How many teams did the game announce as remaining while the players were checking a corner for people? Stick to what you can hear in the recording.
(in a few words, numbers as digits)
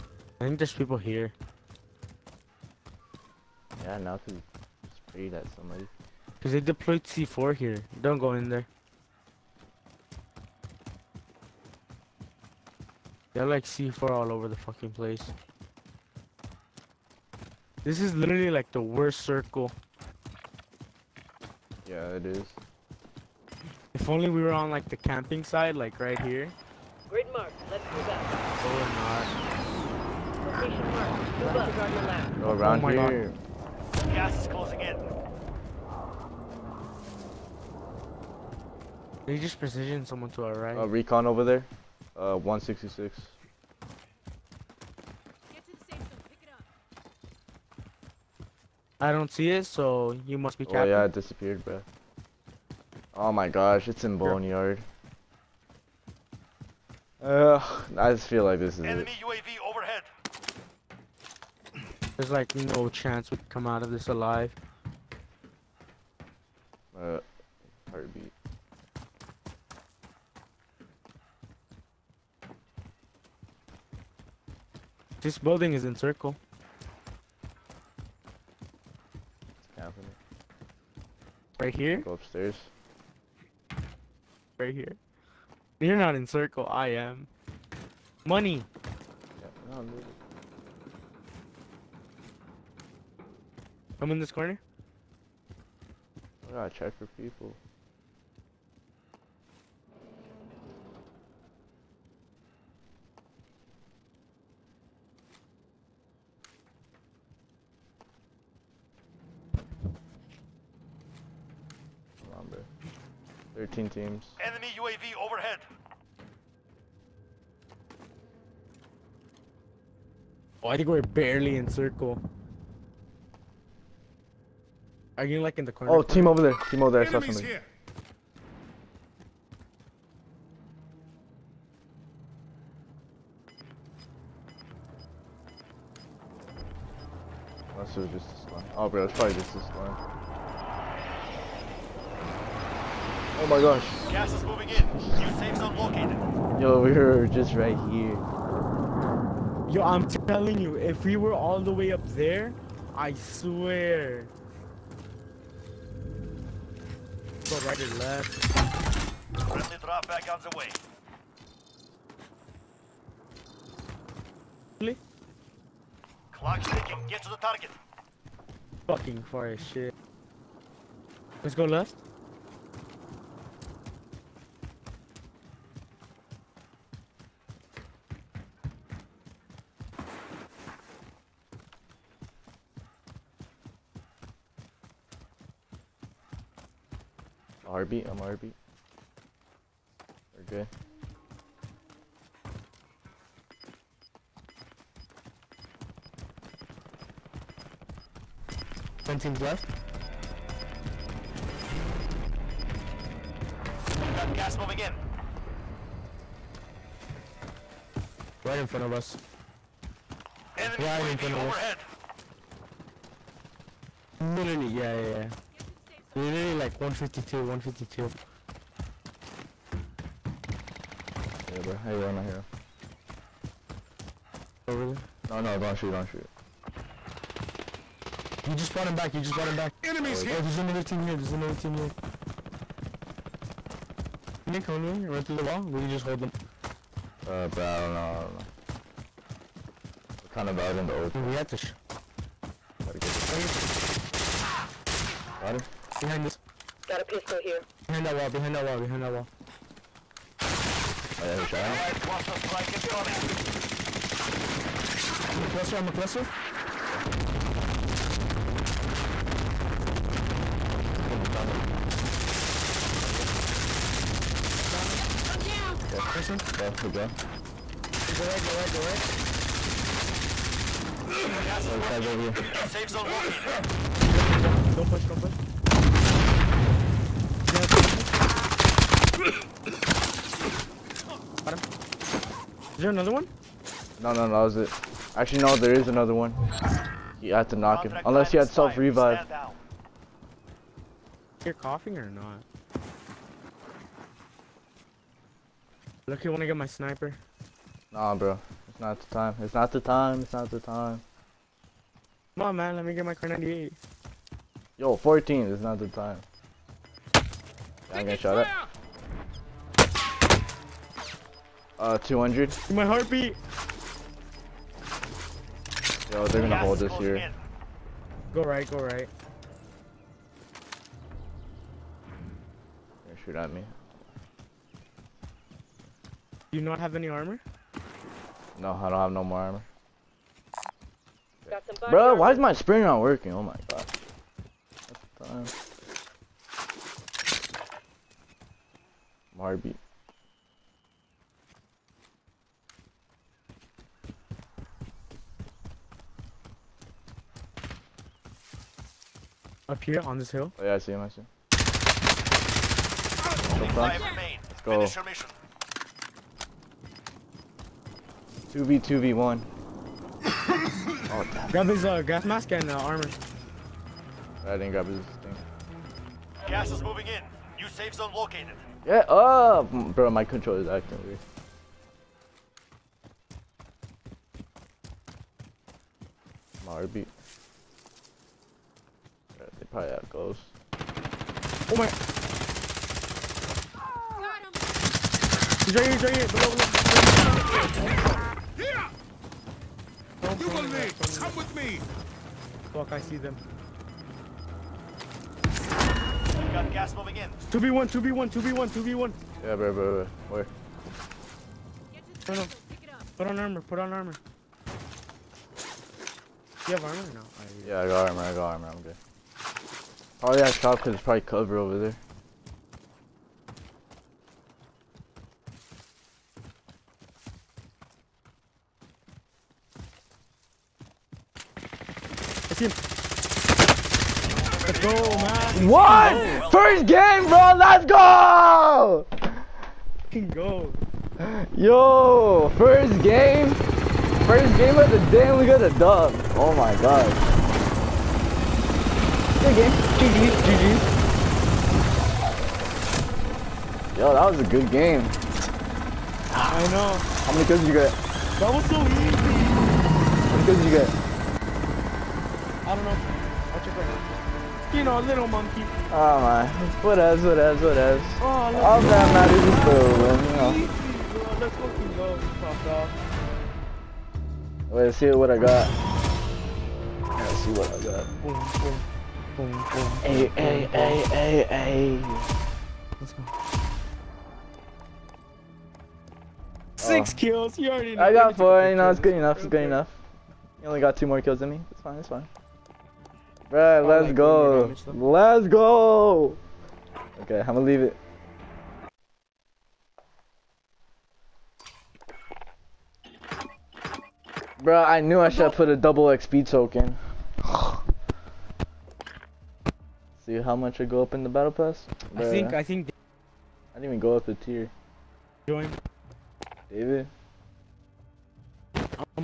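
13.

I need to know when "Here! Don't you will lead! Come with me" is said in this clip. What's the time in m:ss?
6:28.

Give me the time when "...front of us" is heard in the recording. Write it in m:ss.
3:28.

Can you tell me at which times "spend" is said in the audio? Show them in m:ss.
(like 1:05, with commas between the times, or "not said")
not said.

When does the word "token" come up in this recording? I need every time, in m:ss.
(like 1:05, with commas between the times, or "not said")
8:16.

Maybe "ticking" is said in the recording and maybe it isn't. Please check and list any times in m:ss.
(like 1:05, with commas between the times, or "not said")
2:46.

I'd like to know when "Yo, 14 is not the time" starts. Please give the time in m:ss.
5:04.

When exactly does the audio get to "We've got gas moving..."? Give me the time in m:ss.
3:23.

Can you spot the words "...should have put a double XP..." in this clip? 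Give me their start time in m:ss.
8:15.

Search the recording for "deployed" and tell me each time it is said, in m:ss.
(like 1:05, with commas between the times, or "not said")
0:06.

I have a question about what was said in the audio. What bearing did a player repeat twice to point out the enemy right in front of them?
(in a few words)
152.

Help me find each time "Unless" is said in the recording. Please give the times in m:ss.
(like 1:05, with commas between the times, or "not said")
2:17, 4:48.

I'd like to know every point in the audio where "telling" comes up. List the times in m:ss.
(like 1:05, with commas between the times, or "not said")
2:30.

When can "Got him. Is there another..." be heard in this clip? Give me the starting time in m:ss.
4:39.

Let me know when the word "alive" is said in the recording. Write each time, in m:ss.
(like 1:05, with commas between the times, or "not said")
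1:04.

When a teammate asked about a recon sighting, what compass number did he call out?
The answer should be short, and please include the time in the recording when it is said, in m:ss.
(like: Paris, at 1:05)
166, at 0:42.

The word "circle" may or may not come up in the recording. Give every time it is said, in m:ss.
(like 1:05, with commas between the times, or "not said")
0:19, 1:15, 1:26, 2:01.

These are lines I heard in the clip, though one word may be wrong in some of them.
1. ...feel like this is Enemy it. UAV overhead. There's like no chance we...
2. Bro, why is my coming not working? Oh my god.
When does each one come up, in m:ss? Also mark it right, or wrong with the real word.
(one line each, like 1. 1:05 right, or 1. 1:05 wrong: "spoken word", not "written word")
1. 0:58 right
2. 5:31 wrong: "spring", not "coming".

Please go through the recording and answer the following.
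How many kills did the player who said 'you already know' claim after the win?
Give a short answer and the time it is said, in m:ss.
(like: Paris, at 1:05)
6, at 7:56.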